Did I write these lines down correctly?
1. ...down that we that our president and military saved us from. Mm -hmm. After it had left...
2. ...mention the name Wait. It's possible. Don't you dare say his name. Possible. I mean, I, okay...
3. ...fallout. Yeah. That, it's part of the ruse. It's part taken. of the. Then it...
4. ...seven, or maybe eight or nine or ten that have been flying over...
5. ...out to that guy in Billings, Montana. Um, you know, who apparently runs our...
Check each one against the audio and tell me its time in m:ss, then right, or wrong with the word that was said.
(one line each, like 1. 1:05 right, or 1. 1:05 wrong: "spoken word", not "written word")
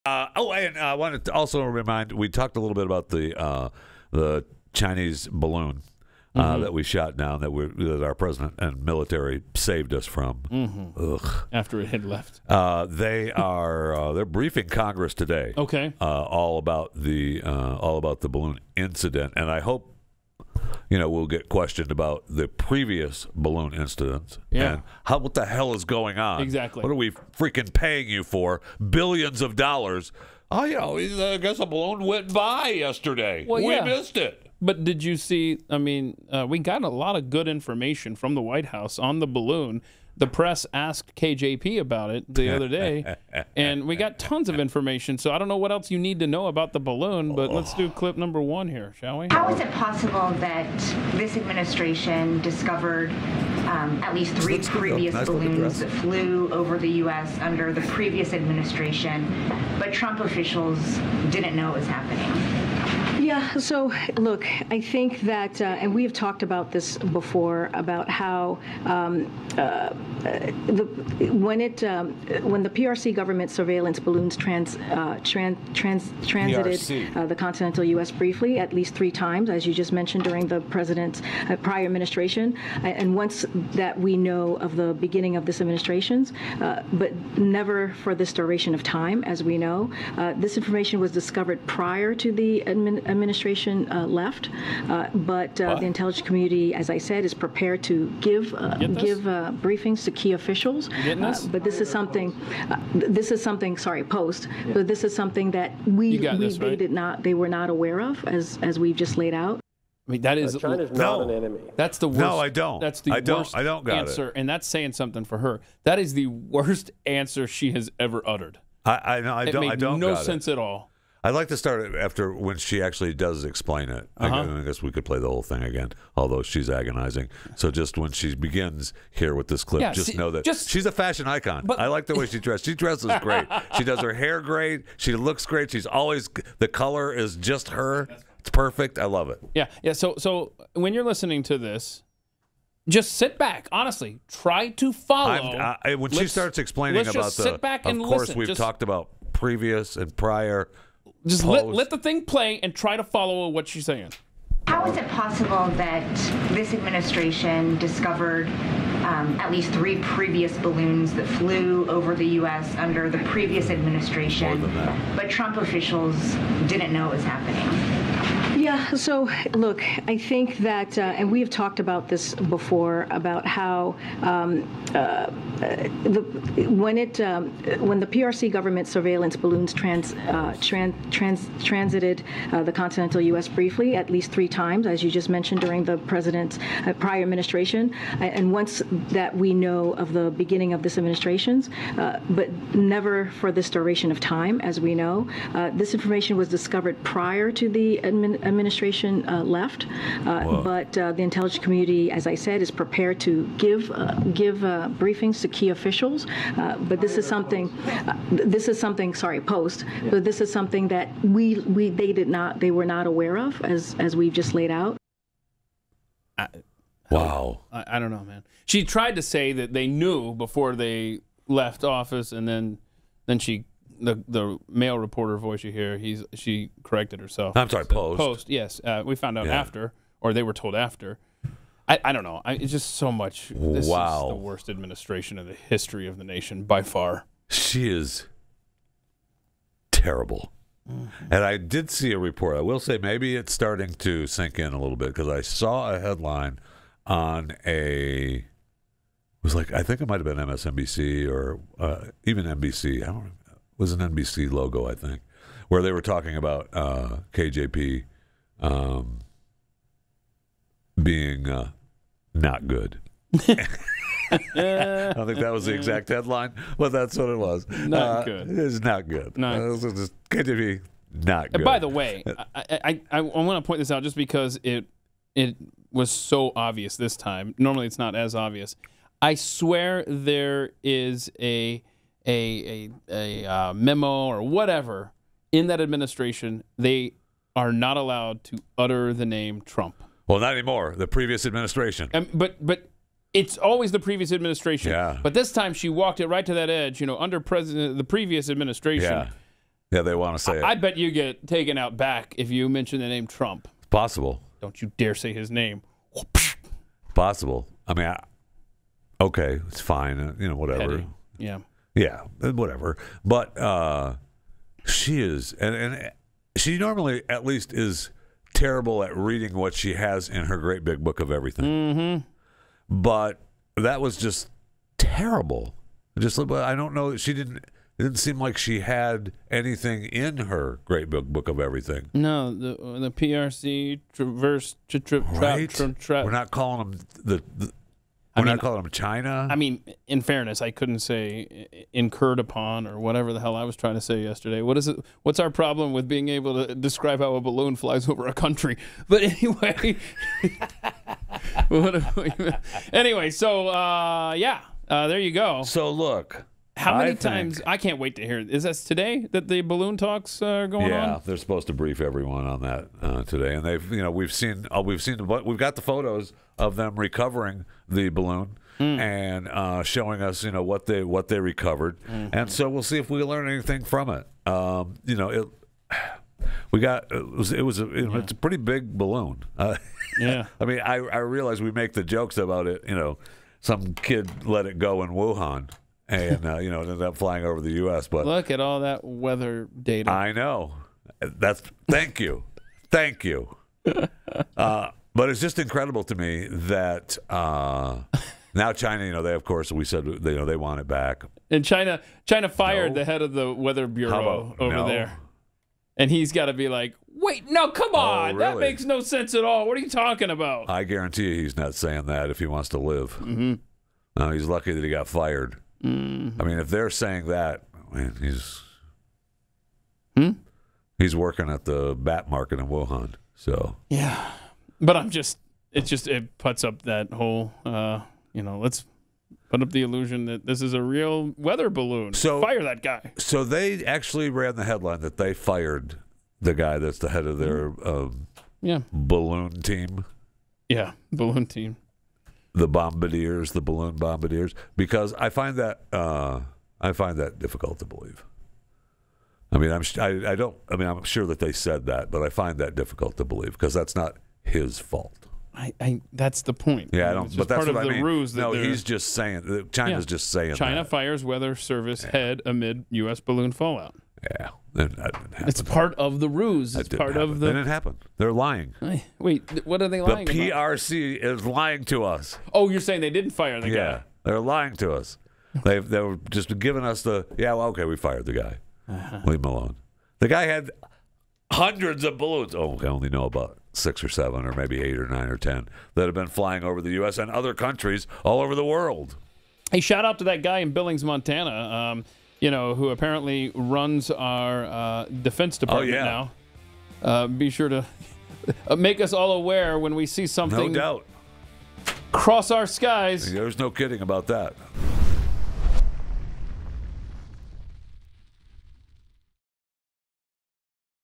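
1. 0:07 right
2. 5:02 wrong: "Trump", not "Wait"
3. 7:43 wrong: "happen", not "taken"
4. 8:04 right
5. 8:10 right.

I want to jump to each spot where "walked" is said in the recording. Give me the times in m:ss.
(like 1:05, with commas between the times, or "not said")
4:55.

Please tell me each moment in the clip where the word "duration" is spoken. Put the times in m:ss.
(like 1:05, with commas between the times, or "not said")
1:28, 3:13.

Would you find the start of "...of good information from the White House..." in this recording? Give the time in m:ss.
0:37.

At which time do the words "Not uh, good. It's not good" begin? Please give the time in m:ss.
4:27.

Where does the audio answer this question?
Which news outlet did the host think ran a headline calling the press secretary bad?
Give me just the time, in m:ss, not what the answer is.
4:10.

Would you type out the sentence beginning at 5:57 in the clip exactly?
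Think, I can't wait to hear.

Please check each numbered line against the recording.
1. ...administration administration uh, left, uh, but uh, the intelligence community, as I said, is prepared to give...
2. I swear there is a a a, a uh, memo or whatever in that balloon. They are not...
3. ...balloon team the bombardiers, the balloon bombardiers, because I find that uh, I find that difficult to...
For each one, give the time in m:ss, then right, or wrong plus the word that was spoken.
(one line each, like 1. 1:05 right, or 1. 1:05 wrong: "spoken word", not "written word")
1. 1:32 right
2. 4:39 wrong: "administration", not "balloon"
3. 7:21 right.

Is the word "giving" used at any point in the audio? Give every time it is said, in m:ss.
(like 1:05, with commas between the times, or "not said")
7:56.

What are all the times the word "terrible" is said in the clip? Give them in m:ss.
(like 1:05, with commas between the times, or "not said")
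3:59, 5:18, 5:24.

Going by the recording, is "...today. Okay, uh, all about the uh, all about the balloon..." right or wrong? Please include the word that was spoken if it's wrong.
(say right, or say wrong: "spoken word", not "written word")
right.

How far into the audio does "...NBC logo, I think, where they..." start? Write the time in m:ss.
4:13.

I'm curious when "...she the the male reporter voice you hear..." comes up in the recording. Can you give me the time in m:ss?
3:43.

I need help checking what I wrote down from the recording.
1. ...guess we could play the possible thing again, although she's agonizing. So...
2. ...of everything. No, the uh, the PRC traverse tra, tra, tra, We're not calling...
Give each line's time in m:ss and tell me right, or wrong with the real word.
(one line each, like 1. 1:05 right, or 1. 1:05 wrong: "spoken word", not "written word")
1. 2:04 wrong: "whole", not "possible"
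2. 5:31 right.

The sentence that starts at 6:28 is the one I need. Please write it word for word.
But look at all that weather data.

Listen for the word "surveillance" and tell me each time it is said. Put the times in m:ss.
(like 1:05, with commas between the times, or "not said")
1:13, 2:58.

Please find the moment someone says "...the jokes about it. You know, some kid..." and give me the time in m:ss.
6:21.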